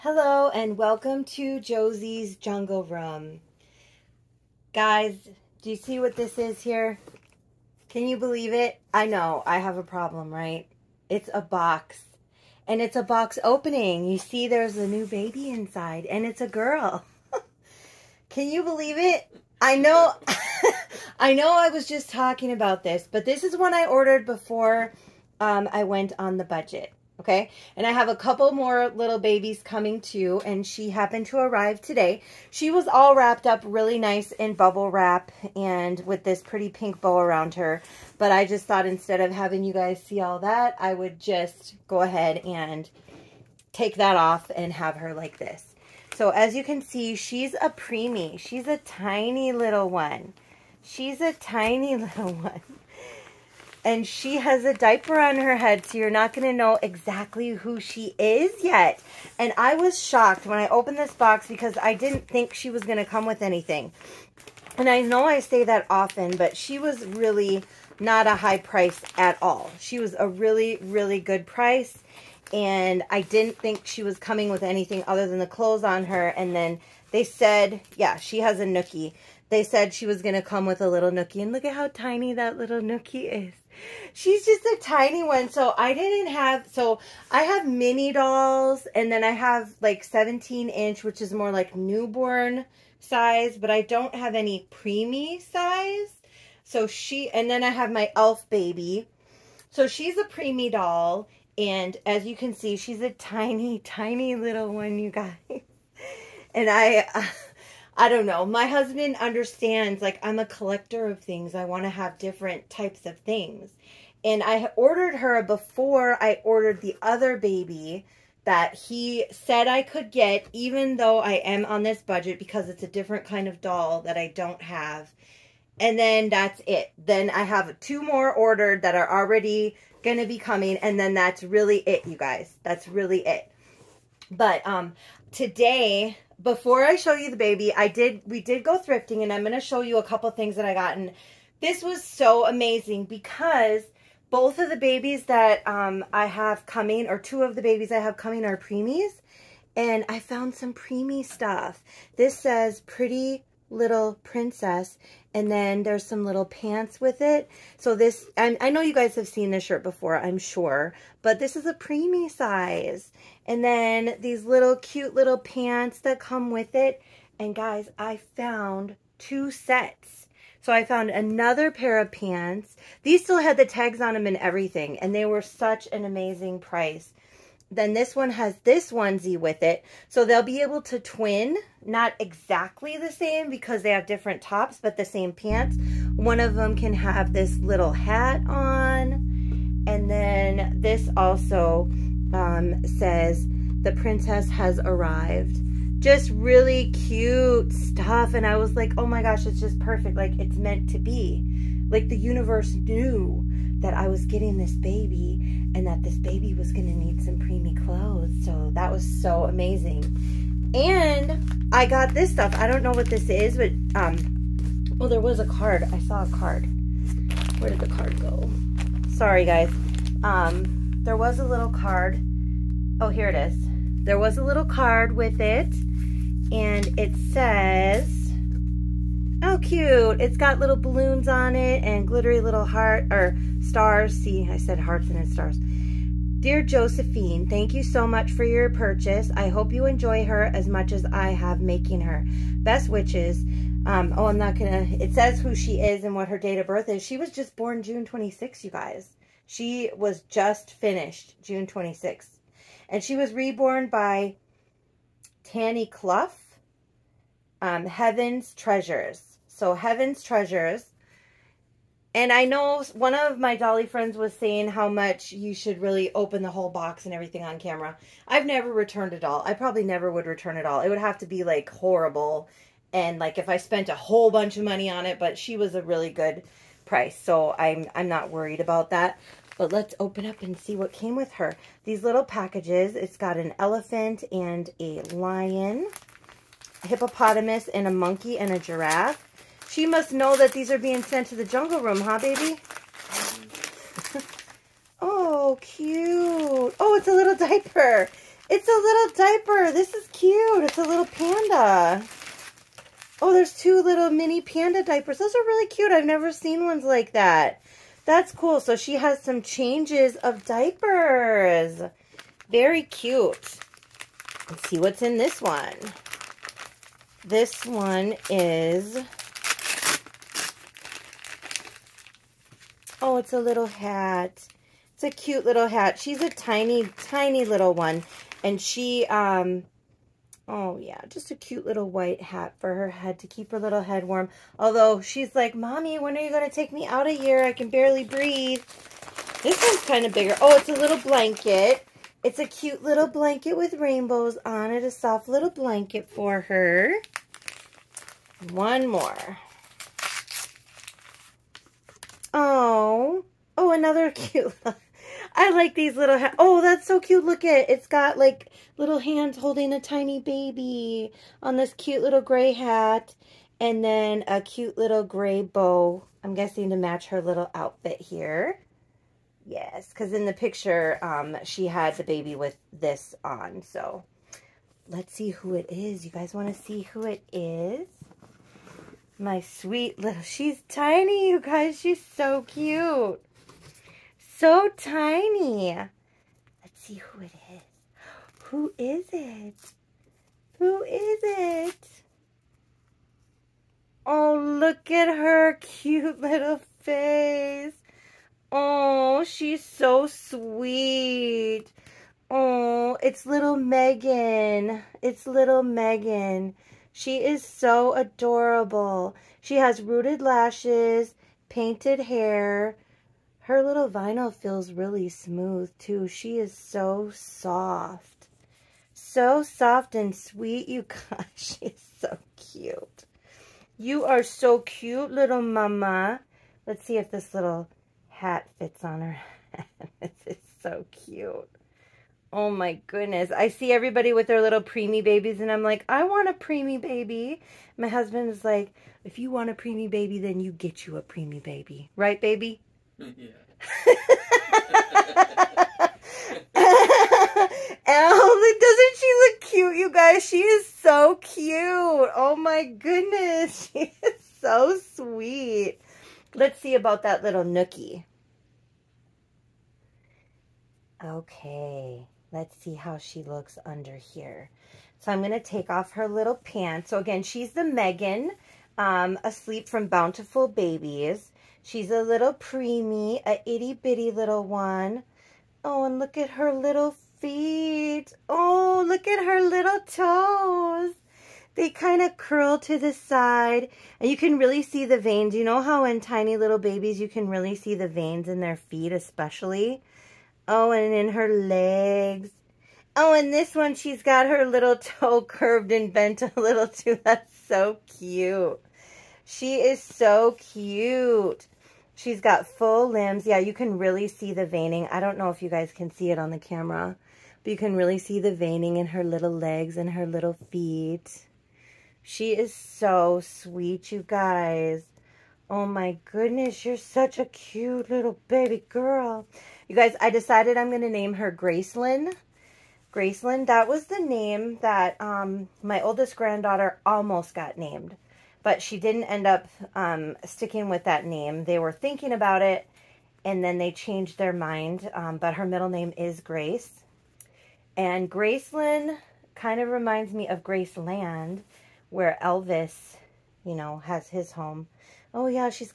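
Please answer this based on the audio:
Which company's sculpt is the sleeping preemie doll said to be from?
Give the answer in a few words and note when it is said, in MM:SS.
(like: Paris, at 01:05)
Bountiful Babies, at 07:49.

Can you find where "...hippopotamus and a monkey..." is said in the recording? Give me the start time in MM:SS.
04:46.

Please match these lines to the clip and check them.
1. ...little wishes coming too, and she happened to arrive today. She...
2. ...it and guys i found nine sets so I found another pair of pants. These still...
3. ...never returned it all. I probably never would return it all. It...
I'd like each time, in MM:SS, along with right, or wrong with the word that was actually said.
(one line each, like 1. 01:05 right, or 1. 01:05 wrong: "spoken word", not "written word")
1. 00:28 wrong: "babies", not "wishes"
2. 02:46 wrong: "two", not "nine"
3. 04:28 right.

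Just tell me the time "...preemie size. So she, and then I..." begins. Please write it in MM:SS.
01:34.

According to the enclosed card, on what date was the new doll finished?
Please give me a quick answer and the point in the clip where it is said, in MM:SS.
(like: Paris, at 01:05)
June 26, at 04:07.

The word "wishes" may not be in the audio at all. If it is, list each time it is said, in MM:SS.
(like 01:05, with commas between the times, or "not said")
04:02.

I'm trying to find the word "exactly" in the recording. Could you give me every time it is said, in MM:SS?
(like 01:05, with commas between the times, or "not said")
00:56, 03:02.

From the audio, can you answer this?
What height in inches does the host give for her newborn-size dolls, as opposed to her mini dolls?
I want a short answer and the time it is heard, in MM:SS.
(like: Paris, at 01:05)
17, at 01:30.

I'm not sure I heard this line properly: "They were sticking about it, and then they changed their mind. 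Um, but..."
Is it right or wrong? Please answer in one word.
wrong.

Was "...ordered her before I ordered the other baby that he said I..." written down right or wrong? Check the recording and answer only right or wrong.
right.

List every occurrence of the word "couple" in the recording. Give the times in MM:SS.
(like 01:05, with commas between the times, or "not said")
00:28, 02:20.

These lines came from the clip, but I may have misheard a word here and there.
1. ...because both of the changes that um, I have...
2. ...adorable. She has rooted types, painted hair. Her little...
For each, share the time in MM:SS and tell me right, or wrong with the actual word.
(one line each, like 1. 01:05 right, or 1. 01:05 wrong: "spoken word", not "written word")
1. 02:23 wrong: "babies", not "changes"
2. 06:47 wrong: "lashes", not "types".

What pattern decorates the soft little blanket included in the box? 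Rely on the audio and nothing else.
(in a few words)
Rainbows.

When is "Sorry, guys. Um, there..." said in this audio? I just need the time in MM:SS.
03:39.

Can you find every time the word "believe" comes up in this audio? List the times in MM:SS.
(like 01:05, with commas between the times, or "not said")
00:08, 00:18.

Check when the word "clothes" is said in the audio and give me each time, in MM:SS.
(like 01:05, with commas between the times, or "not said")
01:15, 03:27.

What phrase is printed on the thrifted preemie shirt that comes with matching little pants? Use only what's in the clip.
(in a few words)
Pretty little princess.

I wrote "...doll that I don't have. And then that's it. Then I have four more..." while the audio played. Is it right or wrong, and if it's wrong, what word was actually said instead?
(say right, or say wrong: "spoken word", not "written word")
wrong: "two", not "four".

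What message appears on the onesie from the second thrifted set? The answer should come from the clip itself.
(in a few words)
The princess has arrived.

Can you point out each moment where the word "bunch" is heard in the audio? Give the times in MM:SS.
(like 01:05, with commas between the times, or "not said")
04:34.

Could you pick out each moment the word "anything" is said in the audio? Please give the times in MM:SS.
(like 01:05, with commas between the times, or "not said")
01:03, 01:14.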